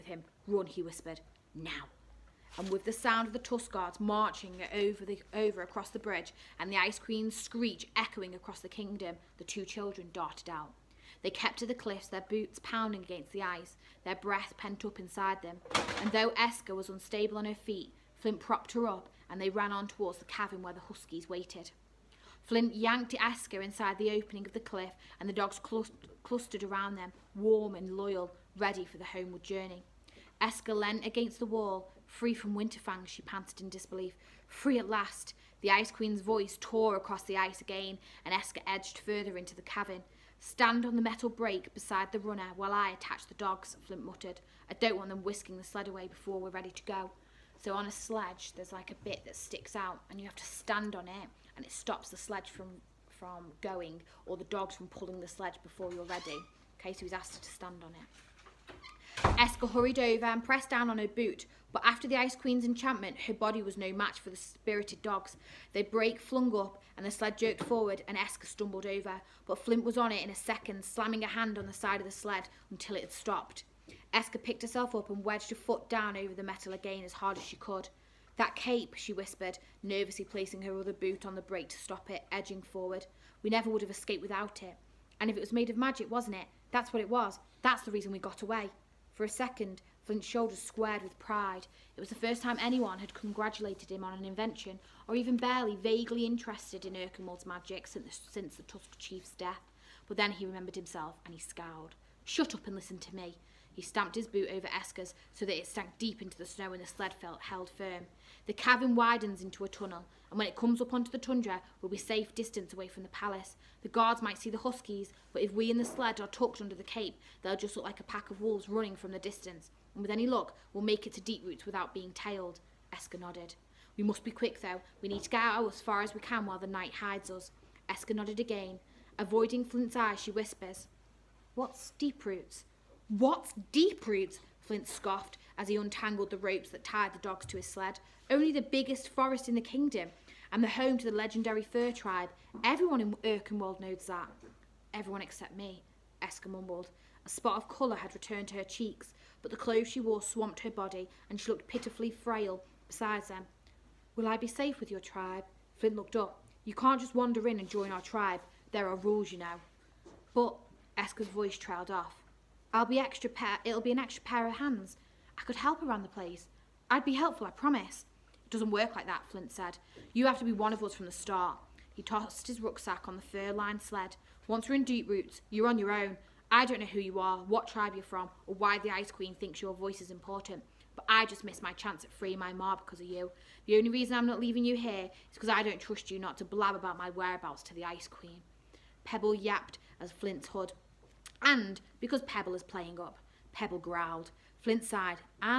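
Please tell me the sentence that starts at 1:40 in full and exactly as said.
But then he remembered himself and he scowled.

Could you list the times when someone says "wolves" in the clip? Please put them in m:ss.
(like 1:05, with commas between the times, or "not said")
1:58.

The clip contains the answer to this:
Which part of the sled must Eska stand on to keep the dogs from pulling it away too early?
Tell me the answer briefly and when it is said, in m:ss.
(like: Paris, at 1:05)
the metal brake, at 0:41.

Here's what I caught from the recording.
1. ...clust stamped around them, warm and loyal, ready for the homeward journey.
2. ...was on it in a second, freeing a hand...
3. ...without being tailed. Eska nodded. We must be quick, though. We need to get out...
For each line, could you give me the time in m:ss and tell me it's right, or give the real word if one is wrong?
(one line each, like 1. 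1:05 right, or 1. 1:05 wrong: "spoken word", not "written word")
1. 0:25 wrong: "clustered", not "stamped"
2. 1:09 wrong: "slamming", not "freeing"
3. 2:01 right.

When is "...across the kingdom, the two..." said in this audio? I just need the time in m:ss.
0:08.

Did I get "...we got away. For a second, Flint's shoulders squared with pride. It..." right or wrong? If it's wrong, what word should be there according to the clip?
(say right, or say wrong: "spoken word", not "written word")
right.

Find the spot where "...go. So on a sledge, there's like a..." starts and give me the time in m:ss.
0:46.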